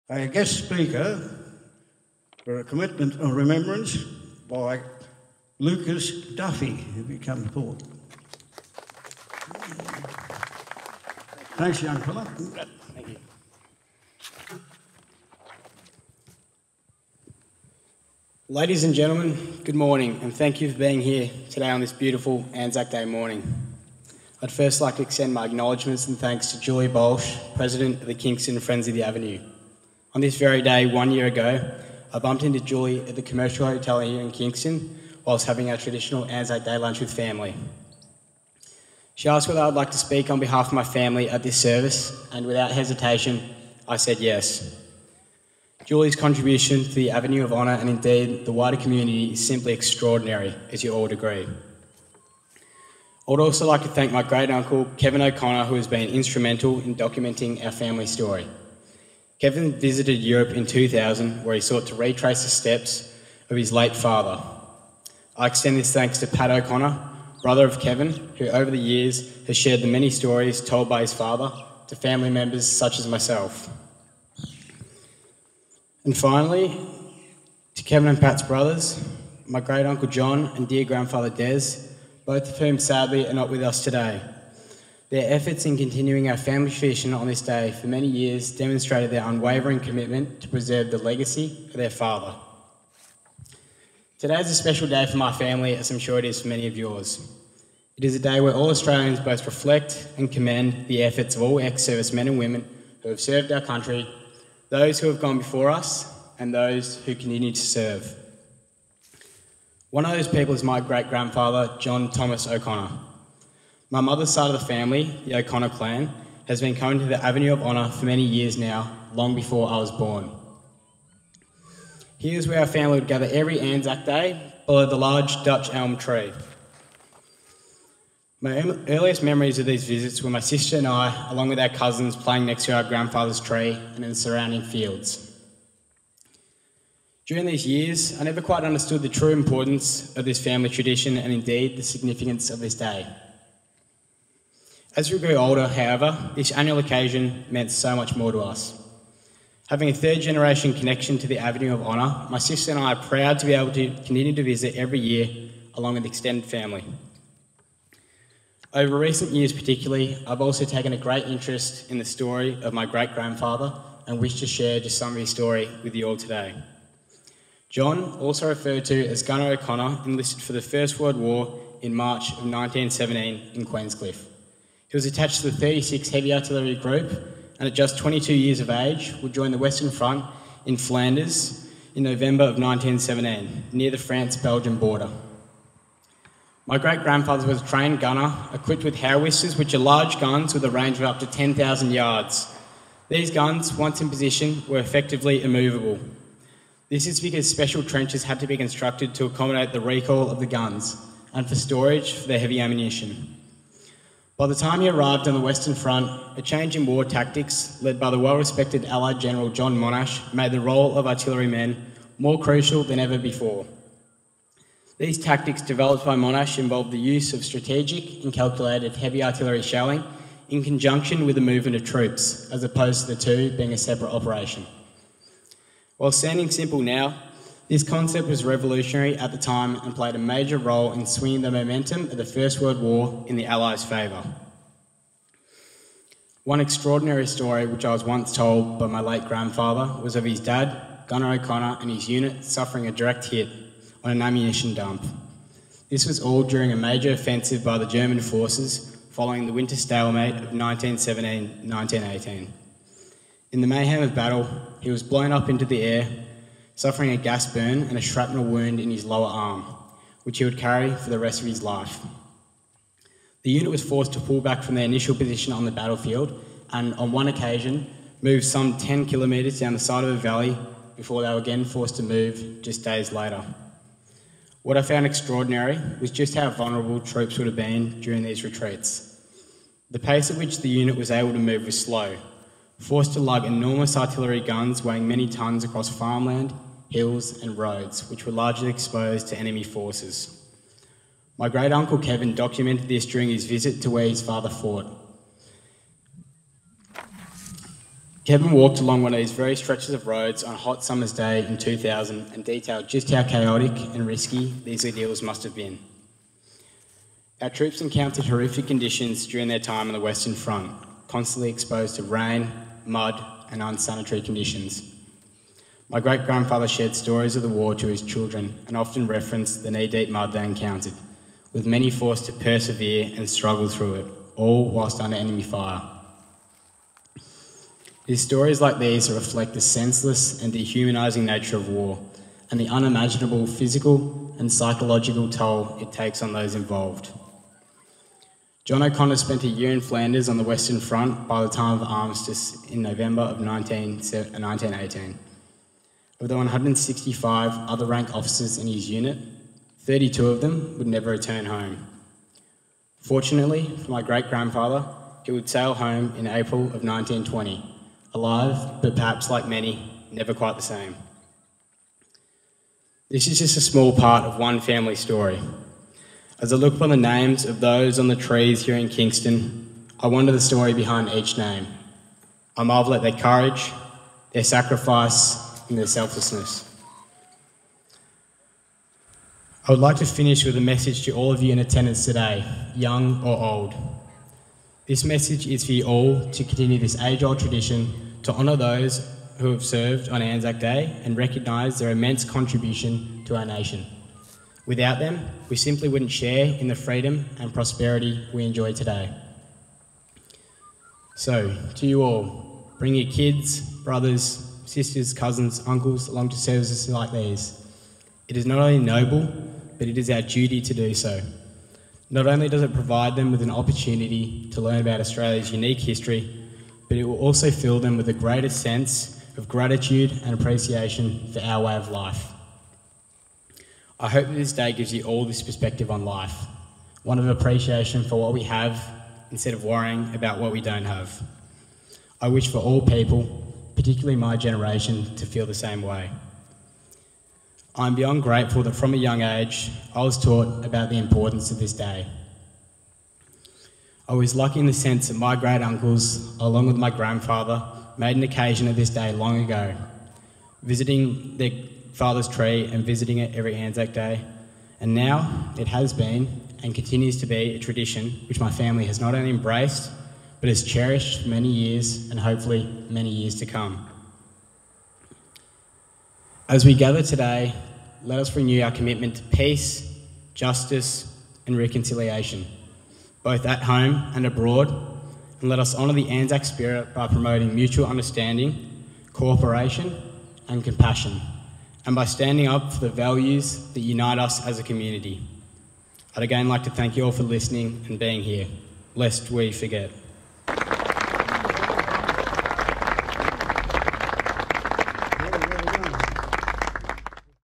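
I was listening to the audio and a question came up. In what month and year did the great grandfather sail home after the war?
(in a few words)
April 1920.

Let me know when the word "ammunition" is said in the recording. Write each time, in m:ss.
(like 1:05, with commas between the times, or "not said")
3:22, 4:04.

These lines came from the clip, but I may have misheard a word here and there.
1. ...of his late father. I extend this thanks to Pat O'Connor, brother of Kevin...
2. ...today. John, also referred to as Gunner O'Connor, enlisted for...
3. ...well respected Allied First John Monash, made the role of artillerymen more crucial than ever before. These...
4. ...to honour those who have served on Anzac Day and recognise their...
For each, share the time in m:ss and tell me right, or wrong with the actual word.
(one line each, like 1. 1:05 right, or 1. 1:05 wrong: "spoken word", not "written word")
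1. 1:03 right
2. 2:46 right
3. 3:28 wrong: "General", not "First"
4. 6:28 right.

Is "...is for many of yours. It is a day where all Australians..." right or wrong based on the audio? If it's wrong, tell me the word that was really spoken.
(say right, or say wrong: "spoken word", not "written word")
right.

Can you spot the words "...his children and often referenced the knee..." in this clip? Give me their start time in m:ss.
5:17.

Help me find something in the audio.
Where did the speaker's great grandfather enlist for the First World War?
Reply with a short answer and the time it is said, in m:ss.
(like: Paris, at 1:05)
Queenscliff, at 2:53.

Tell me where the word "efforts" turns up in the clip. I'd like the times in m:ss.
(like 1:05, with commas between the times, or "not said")
1:25, 1:41.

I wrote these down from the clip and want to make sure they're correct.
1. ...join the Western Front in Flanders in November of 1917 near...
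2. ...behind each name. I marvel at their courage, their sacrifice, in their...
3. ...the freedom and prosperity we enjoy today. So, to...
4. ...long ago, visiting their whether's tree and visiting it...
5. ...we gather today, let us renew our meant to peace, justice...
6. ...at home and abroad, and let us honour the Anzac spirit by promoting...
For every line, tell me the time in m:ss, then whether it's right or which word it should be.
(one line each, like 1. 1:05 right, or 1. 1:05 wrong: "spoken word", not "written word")
1. 2:59 right
2. 6:10 right
3. 6:36 right
4. 7:29 wrong: "father", not "whether"
5. 7:46 wrong: "commitment", not "meant"
6. 7:53 right.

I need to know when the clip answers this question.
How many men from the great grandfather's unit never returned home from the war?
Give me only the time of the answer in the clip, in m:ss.
5:49.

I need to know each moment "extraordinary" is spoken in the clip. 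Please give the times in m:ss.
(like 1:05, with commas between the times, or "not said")
0:49, 3:56, 4:35.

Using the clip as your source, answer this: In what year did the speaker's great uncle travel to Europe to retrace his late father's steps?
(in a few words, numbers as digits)
2000.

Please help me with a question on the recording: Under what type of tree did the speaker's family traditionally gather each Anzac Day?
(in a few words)
Dutch elm.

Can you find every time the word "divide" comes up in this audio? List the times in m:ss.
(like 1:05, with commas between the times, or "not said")
not said.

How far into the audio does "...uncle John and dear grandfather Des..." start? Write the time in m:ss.
1:19.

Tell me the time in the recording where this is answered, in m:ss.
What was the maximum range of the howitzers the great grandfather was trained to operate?
3:11.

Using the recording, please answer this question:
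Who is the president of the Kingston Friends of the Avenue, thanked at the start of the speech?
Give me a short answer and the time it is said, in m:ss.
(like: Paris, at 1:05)
Julie Bolsh, at 0:26.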